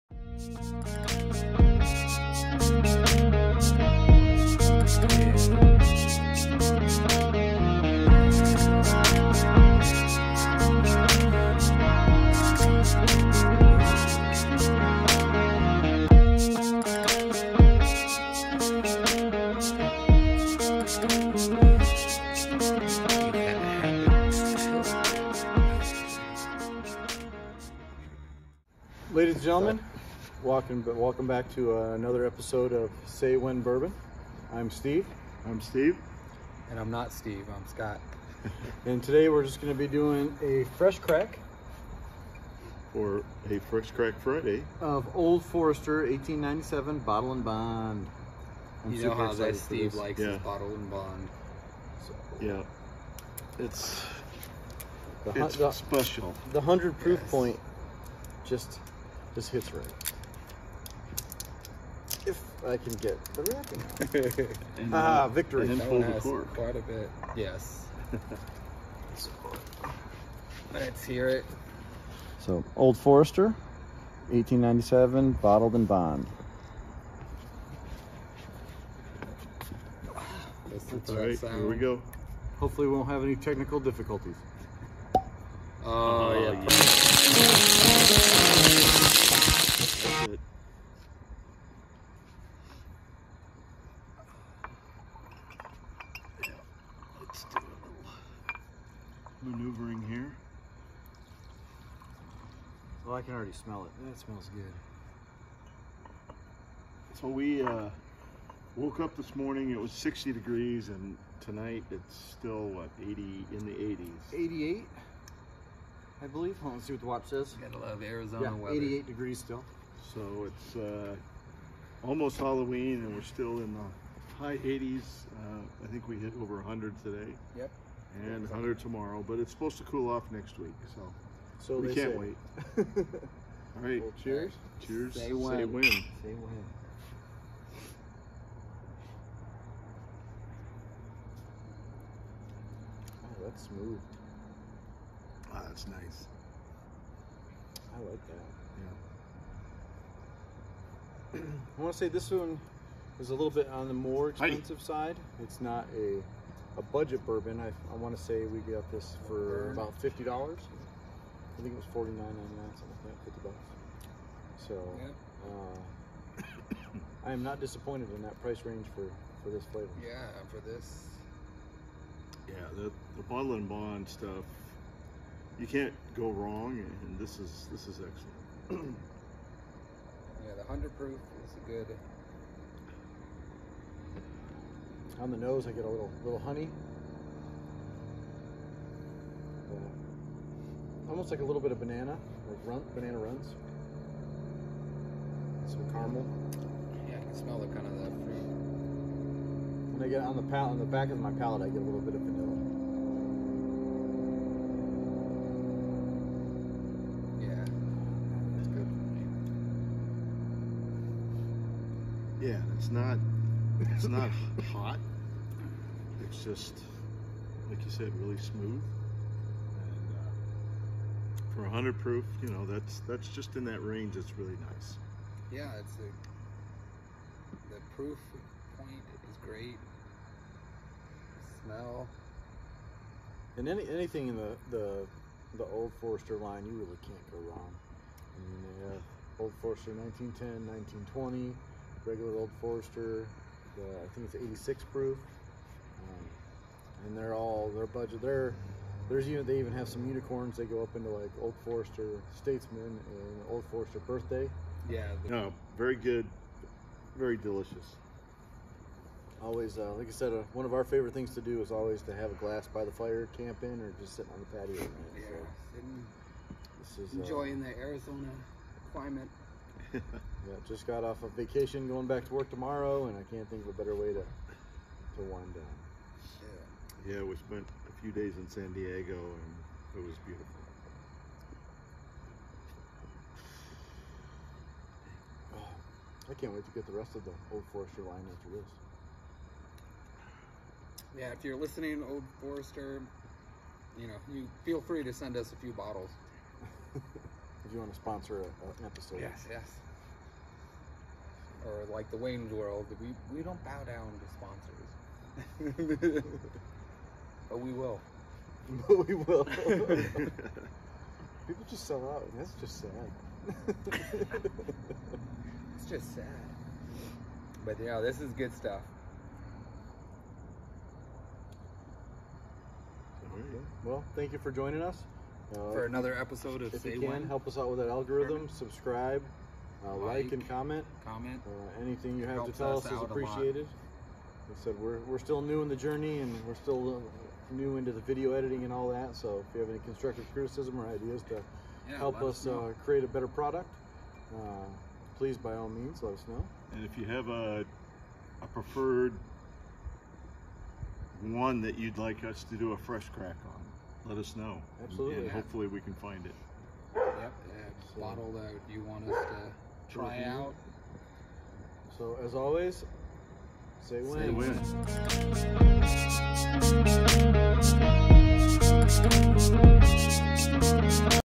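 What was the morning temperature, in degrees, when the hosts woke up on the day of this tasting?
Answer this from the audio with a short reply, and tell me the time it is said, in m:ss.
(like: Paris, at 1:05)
60, at 1:49.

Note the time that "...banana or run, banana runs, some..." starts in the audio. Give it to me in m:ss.
3:11.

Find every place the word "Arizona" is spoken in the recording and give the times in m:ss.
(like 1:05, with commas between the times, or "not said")
1:58, 4:27.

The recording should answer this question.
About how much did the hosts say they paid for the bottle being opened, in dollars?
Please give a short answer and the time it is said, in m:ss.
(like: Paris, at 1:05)
$50, at 2:40.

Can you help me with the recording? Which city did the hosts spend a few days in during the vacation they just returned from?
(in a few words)
San Diego.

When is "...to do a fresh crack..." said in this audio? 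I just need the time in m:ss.
5:52.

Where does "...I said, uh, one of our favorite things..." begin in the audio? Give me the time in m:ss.
4:20.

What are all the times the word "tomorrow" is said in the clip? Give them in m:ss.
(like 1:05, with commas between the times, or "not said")
2:08, 4:32.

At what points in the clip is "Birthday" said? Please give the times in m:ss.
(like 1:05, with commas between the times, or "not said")
4:13.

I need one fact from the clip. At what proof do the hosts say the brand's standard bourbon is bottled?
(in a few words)
86.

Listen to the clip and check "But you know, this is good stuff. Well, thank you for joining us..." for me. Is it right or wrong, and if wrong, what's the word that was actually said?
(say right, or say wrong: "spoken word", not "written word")
right.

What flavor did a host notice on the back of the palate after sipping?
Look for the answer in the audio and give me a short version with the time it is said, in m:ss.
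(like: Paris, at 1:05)
vanilla, at 3:22.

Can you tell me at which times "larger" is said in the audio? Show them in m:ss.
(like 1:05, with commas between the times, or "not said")
not said.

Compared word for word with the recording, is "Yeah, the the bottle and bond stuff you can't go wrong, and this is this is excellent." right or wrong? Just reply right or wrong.
right.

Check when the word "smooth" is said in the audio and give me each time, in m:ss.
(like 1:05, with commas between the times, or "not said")
2:23, 3:38.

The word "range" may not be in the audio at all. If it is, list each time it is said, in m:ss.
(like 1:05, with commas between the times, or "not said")
2:48, 3:43.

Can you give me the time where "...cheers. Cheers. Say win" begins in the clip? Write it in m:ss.
2:14.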